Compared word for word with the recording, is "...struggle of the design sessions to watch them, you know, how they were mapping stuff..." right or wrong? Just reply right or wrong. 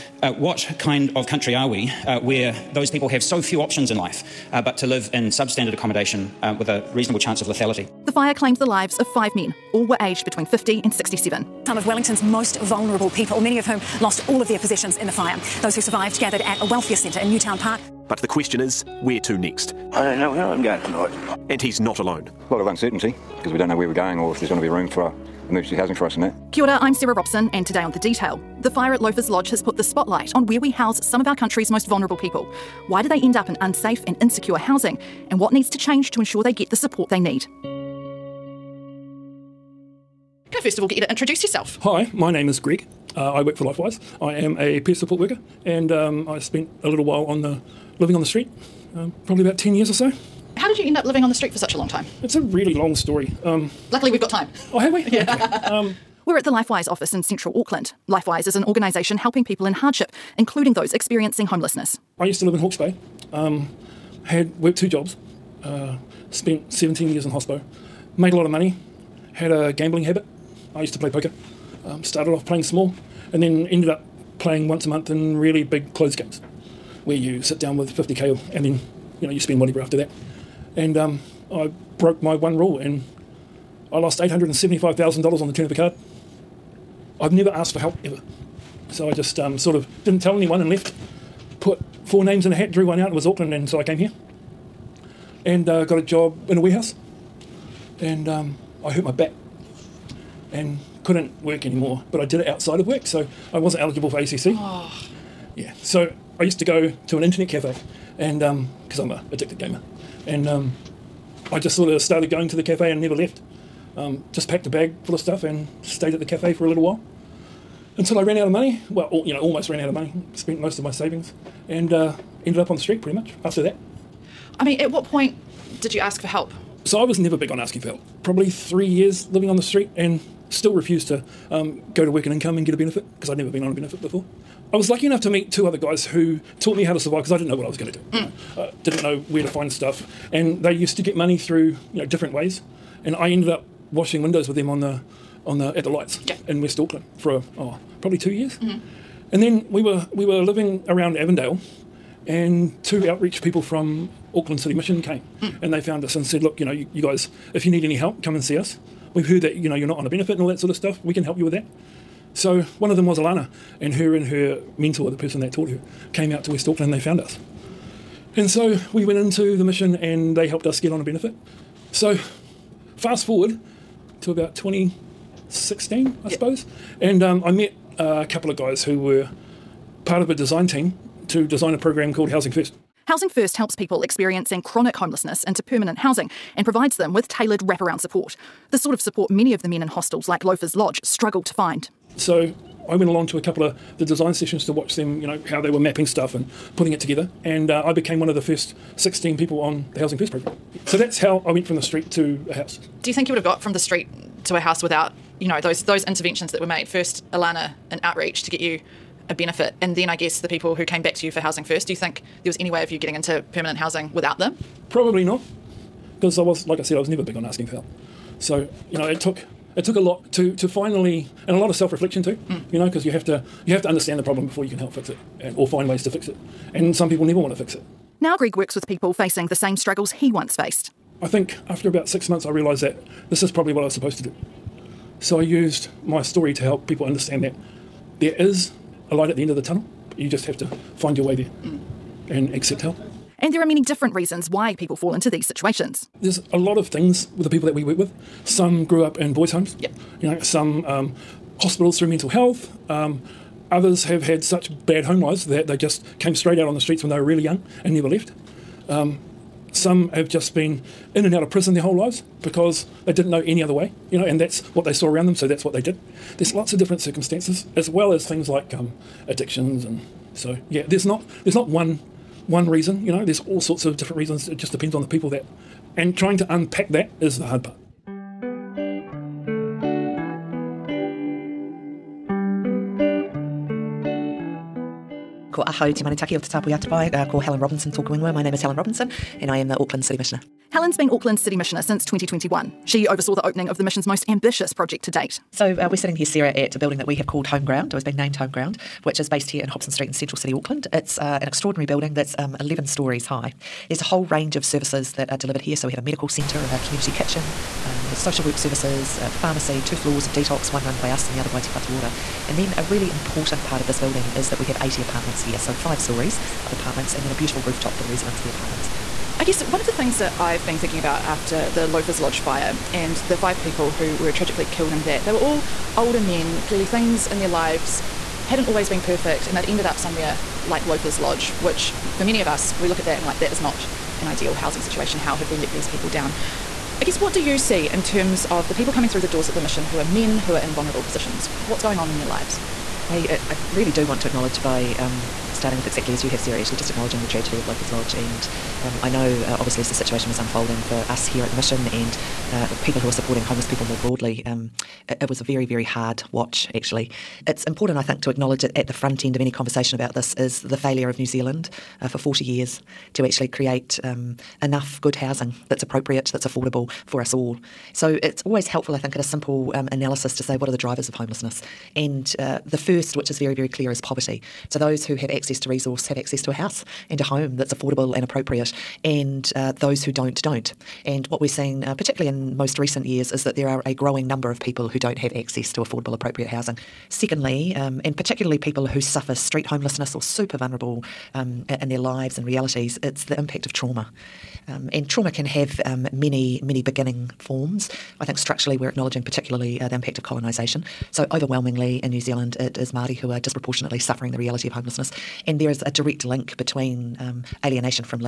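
wrong.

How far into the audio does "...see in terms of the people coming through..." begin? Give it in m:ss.
5:37.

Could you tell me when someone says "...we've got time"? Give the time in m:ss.
0:54.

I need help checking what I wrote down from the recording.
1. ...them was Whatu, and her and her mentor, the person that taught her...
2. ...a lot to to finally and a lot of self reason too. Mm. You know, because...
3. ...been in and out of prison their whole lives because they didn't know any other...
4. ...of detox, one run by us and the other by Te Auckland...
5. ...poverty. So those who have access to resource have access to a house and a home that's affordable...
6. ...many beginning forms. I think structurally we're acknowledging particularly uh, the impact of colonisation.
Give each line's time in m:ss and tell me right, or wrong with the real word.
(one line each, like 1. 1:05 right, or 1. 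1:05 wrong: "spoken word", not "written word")
1. 2:42 wrong: "Alana", not "Whatu"
2. 3:39 wrong: "reflection", not "reason"
3. 4:20 right
4. 5:10 wrong: "Whatu", not "Auckland"
5. 6:13 right
6. 6:36 right.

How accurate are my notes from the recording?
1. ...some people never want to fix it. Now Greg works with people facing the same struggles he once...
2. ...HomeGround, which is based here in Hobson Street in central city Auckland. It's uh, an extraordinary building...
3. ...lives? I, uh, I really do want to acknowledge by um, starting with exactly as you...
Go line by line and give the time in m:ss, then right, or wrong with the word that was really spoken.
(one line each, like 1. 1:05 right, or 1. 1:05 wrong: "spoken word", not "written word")
1. 3:46 right
2. 4:58 right
3. 5:42 right.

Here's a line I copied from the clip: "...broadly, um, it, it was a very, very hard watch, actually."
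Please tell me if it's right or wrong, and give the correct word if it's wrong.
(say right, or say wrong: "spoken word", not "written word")
right.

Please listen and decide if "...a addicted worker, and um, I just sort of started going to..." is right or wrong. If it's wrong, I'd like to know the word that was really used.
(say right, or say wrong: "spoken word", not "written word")
wrong: "gamer", not "worker".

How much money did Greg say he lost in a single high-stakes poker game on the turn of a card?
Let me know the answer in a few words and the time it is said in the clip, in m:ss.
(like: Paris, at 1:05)
$875,000, at 1:24.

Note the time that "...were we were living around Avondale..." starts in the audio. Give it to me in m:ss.
2:29.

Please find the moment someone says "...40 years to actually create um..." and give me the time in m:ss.
6:02.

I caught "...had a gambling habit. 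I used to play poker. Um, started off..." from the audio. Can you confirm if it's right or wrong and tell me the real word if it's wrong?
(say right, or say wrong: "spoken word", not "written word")
right.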